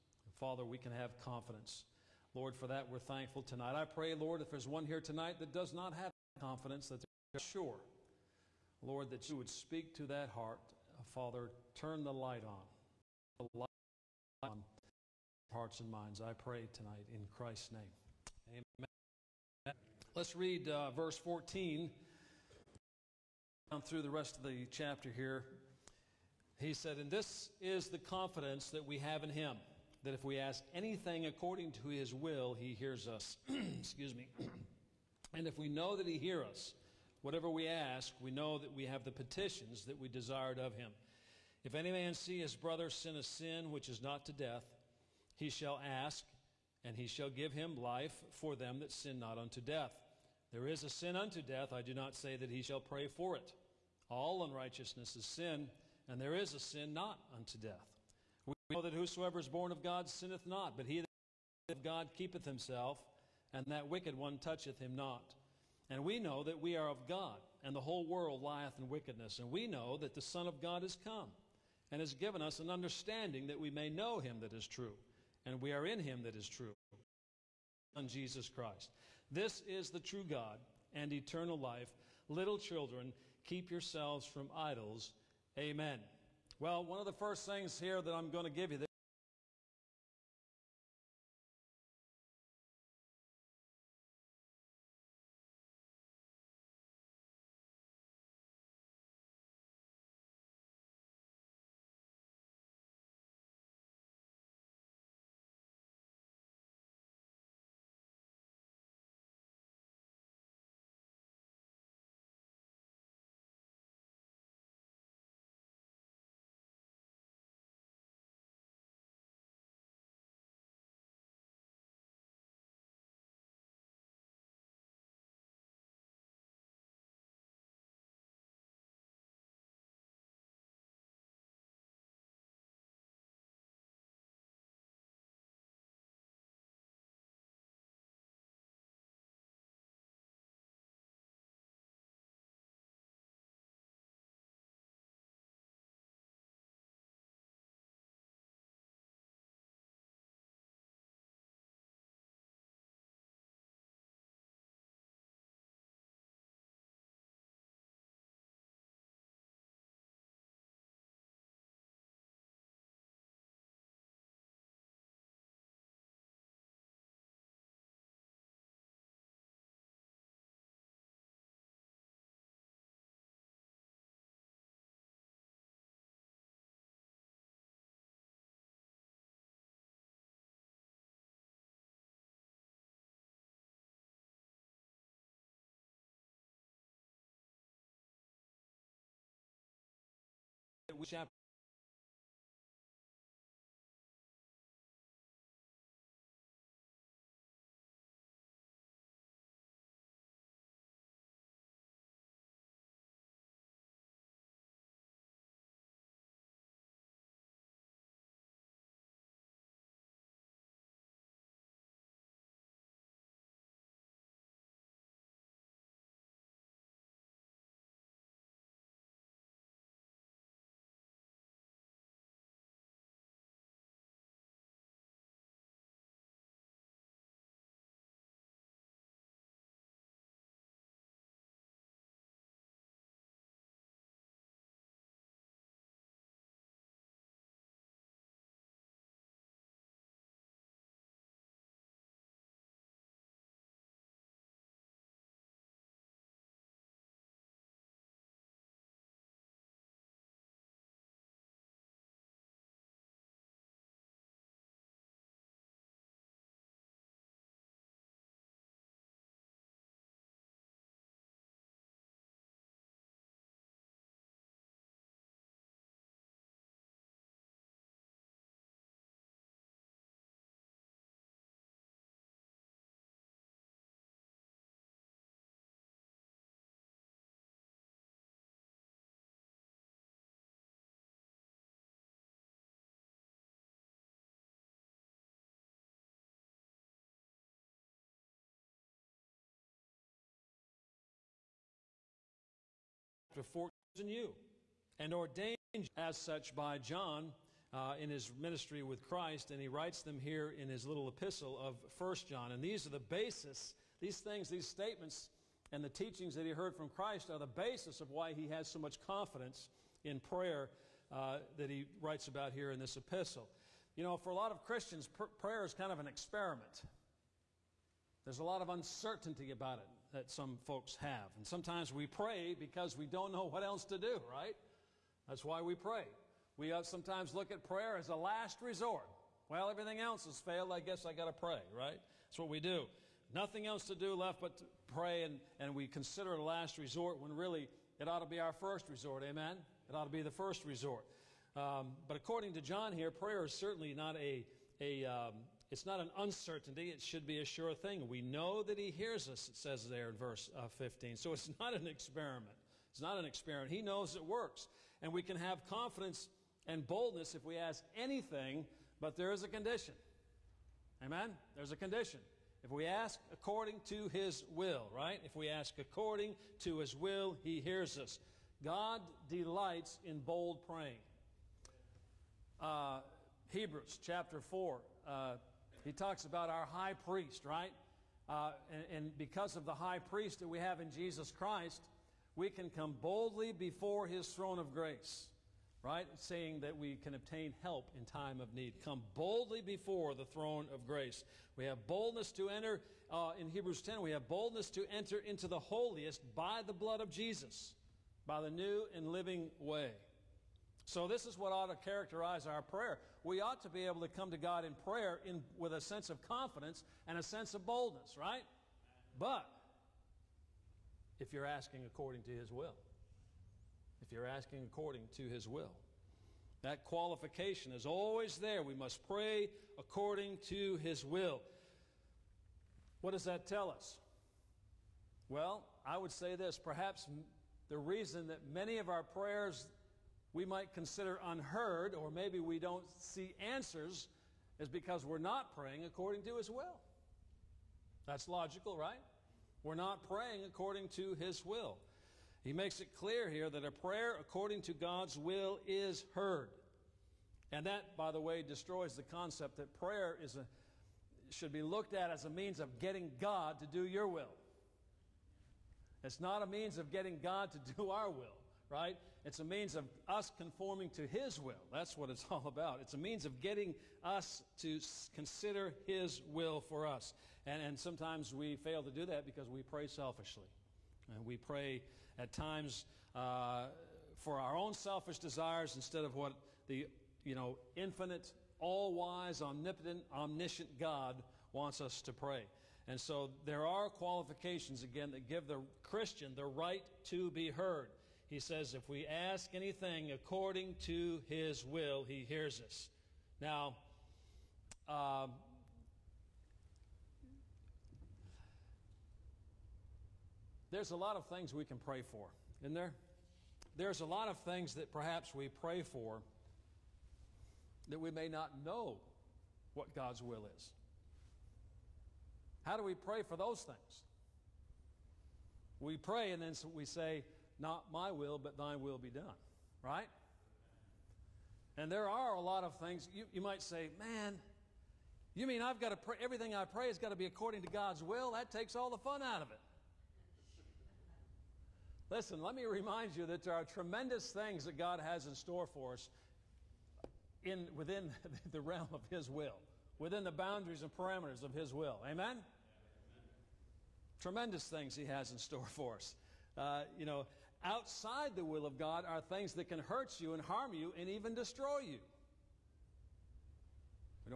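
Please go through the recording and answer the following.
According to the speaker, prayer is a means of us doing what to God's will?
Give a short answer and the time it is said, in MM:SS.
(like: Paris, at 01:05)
Conforming, at 07:40.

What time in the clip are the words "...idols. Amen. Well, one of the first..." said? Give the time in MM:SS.
01:24.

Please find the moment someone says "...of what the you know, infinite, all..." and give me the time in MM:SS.
07:56.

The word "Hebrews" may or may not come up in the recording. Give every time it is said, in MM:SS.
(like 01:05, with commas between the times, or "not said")
06:13, 06:33.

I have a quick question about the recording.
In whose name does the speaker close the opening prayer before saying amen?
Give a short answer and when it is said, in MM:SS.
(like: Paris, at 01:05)
Christ's name, at 00:17.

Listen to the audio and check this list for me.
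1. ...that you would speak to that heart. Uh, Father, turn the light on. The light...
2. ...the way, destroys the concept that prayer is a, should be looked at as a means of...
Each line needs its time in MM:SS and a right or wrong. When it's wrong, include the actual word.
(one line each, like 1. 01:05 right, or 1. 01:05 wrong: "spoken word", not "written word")
1. 00:09 right
2. 07:28 right.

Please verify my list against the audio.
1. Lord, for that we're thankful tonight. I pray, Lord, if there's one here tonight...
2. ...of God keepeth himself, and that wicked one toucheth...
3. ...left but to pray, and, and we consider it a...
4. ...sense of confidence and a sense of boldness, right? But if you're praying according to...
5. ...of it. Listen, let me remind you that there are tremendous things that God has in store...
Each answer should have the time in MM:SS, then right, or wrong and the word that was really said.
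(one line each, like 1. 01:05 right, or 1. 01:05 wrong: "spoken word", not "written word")
1. 00:02 right
2. 01:01 right
3. 05:34 right
4. 06:45 wrong: "asking", not "praying"
5. 08:49 right.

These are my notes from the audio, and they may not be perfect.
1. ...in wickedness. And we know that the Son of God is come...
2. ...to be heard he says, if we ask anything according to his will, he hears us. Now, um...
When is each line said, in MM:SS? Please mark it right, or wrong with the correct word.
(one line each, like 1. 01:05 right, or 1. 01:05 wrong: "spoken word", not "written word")
1. 01:08 right
2. 08:07 right.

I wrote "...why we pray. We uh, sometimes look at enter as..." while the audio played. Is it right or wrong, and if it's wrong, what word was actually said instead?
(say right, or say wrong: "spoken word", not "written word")
wrong: "prayer", not "enter".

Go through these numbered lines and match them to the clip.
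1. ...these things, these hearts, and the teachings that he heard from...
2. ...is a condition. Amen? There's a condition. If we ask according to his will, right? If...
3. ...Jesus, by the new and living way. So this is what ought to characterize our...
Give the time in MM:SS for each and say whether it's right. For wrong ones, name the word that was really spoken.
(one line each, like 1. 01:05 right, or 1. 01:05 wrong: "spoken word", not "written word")
1. 05:03 wrong: "statements", not "hearts"
2. 05:59 right
3. 06:37 right.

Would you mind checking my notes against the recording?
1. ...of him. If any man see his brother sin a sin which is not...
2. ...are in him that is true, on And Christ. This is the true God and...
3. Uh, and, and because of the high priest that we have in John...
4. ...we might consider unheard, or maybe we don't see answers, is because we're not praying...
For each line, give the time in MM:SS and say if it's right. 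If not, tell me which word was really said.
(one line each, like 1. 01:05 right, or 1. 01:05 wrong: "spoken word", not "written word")
1. 00:40 right
2. 01:15 wrong: "Jesus", not "And"
3. 06:18 wrong: "Jesus", not "John"
4. 07:10 right.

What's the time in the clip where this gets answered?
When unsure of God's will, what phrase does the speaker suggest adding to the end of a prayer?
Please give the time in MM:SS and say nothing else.
08:37.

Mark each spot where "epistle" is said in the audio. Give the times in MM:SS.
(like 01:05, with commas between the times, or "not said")
05:01, 05:12.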